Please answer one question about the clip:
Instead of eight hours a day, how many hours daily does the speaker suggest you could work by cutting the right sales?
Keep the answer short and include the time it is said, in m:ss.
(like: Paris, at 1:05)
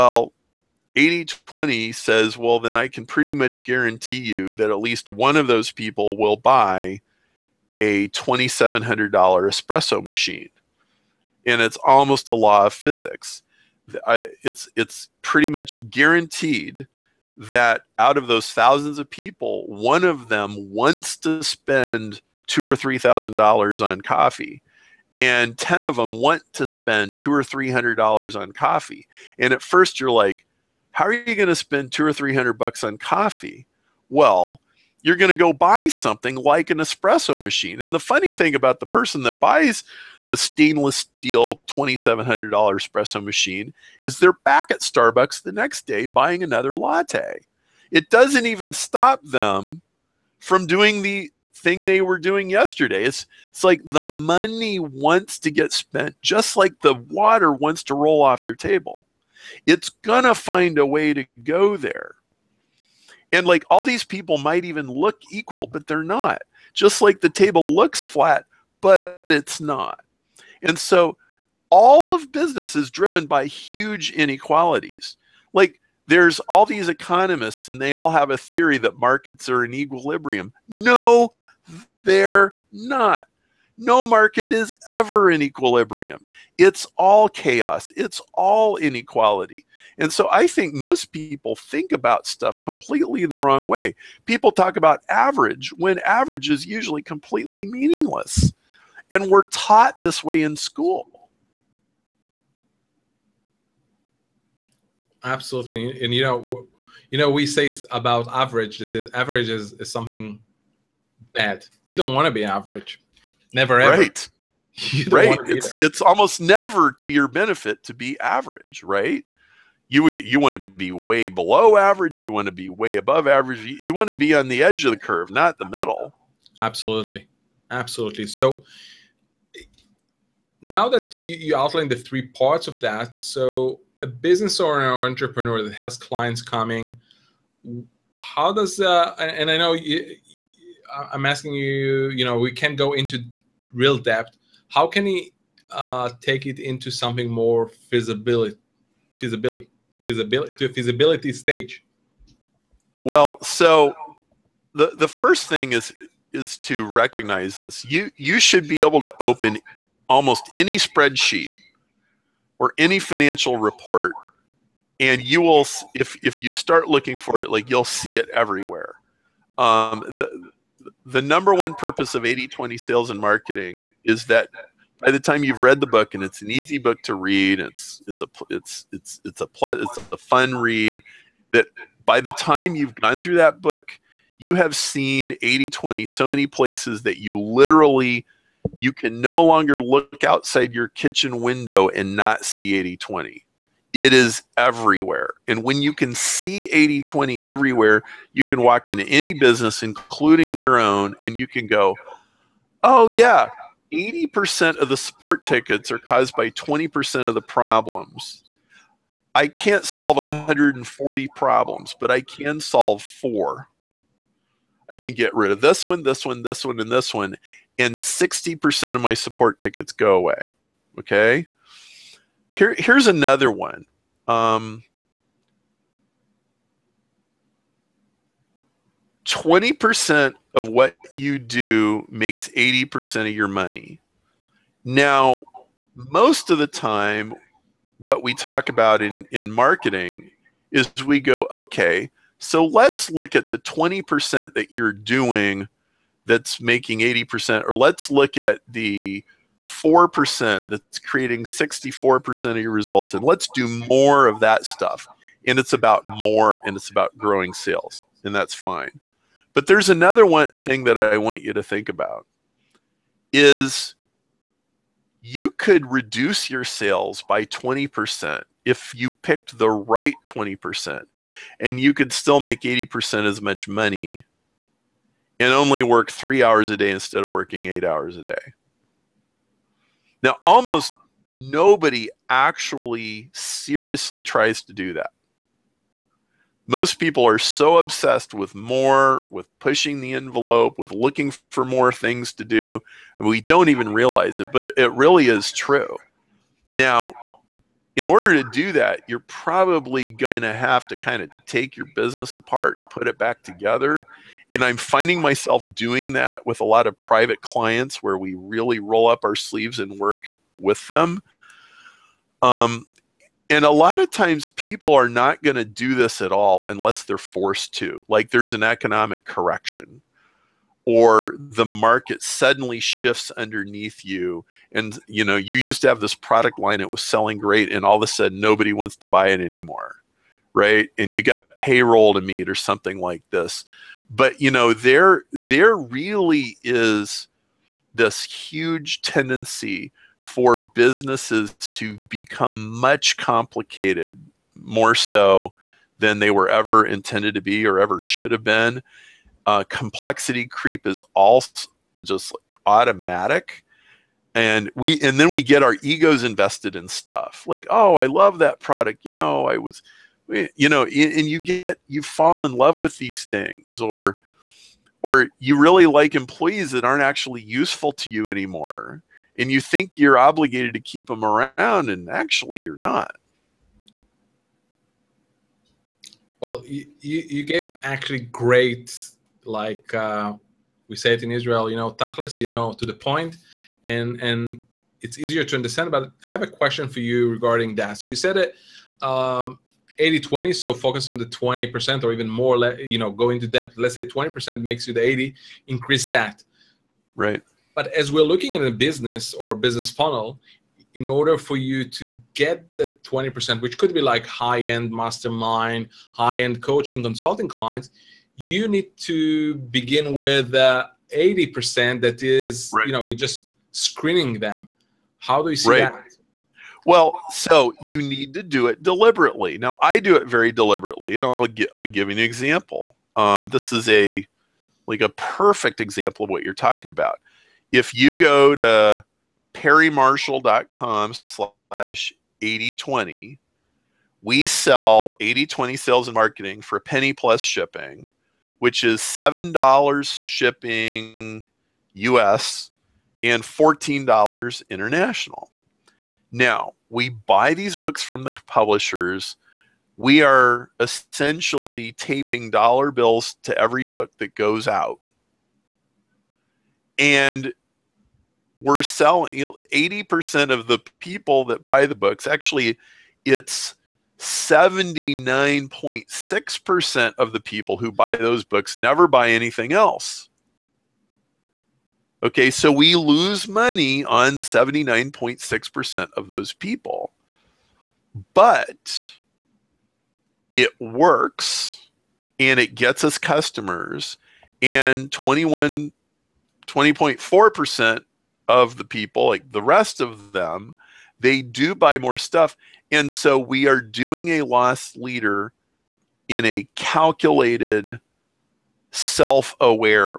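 3, at 4:36.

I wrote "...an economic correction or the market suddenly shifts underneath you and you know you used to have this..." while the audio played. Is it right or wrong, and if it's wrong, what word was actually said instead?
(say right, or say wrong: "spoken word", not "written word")
right.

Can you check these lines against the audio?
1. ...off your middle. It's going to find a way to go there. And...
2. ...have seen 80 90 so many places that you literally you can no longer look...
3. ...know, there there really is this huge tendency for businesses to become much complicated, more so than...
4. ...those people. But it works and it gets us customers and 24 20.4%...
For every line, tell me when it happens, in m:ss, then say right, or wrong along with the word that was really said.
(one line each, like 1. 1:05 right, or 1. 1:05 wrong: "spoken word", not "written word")
1. 0:58 wrong: "table", not "middle"
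2. 3:04 wrong: "20", not "90"
3. 5:34 right
4. 7:56 wrong: "21", not "24".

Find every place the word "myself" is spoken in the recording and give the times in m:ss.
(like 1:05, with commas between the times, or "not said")
5:05.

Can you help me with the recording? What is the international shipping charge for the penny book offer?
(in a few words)
$14.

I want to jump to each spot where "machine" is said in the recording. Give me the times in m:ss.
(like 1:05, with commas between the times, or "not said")
0:10, 0:37, 0:43.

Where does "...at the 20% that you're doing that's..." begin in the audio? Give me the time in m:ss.
4:03.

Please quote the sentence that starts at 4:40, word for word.
Now, almost nobody actually seriously tries to do that.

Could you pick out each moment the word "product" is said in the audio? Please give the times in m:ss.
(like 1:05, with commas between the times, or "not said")
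5:26, 5:58.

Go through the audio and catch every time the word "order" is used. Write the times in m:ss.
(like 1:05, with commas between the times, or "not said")
4:58, 6:41.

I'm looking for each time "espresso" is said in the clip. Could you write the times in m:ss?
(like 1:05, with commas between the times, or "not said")
0:09, 0:36, 0:42.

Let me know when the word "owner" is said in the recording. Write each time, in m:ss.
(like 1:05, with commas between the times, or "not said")
2:14.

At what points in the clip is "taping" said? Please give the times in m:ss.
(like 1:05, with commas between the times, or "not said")
7:31.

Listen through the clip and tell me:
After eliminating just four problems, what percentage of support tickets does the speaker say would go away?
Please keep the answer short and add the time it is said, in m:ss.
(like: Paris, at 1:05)
60%, at 3:37.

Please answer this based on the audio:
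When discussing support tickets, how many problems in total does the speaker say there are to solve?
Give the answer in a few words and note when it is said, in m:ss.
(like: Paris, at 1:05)
140, at 3:30.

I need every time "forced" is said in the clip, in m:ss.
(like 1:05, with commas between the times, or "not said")
5:17.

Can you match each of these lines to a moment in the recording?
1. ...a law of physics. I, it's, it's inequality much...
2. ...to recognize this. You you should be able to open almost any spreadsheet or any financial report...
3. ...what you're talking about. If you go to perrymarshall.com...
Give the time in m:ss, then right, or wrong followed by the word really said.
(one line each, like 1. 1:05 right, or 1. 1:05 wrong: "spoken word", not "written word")
1. 0:12 wrong: "pretty", not "inequality"
2. 2:36 right
3. 7:06 right.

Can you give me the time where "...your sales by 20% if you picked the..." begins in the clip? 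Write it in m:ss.
4:26.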